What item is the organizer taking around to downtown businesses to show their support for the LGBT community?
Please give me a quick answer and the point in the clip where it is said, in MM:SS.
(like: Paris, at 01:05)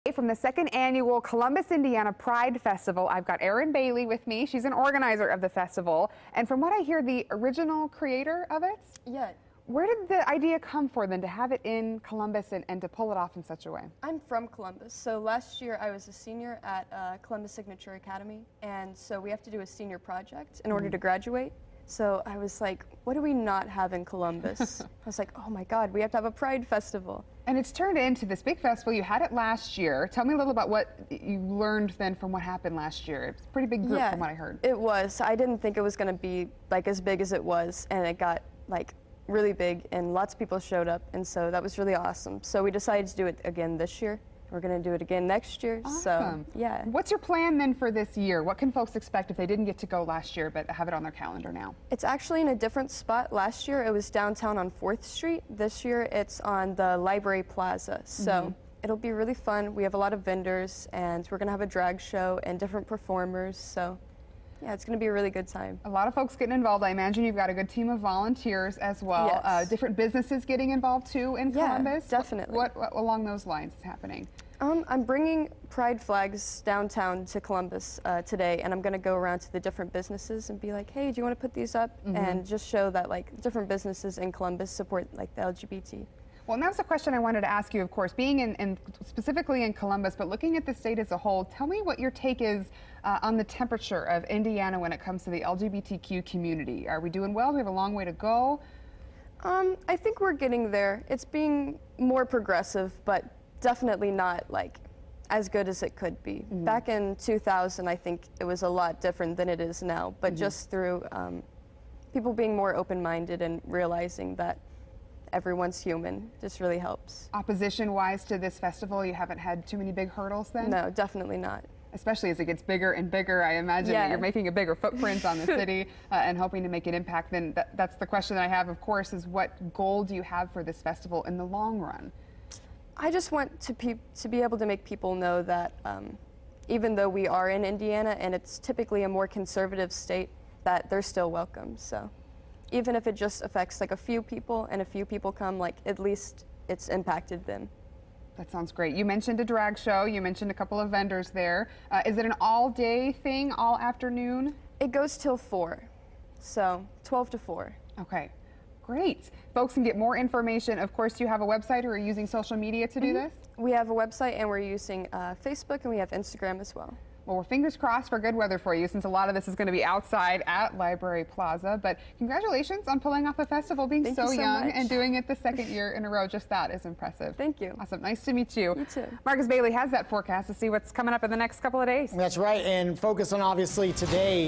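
Pride flags, at 01:15.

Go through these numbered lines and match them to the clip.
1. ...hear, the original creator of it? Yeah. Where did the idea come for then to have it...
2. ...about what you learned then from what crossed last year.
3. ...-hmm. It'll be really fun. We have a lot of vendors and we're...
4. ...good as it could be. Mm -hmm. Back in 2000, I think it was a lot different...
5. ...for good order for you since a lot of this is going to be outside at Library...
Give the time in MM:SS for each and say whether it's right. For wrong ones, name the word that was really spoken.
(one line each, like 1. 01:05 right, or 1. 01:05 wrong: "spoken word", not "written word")
1. 00:06 right
2. 00:30 wrong: "happened", not "crossed"
3. 00:58 right
4. 01:45 right
5. 02:48 wrong: "weather", not "order".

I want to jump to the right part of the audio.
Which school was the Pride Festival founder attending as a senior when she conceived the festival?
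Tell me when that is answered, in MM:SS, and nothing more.
00:17.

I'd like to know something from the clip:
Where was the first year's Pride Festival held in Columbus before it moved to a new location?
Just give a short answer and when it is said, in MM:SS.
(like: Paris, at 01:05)
4th Street, at 00:54.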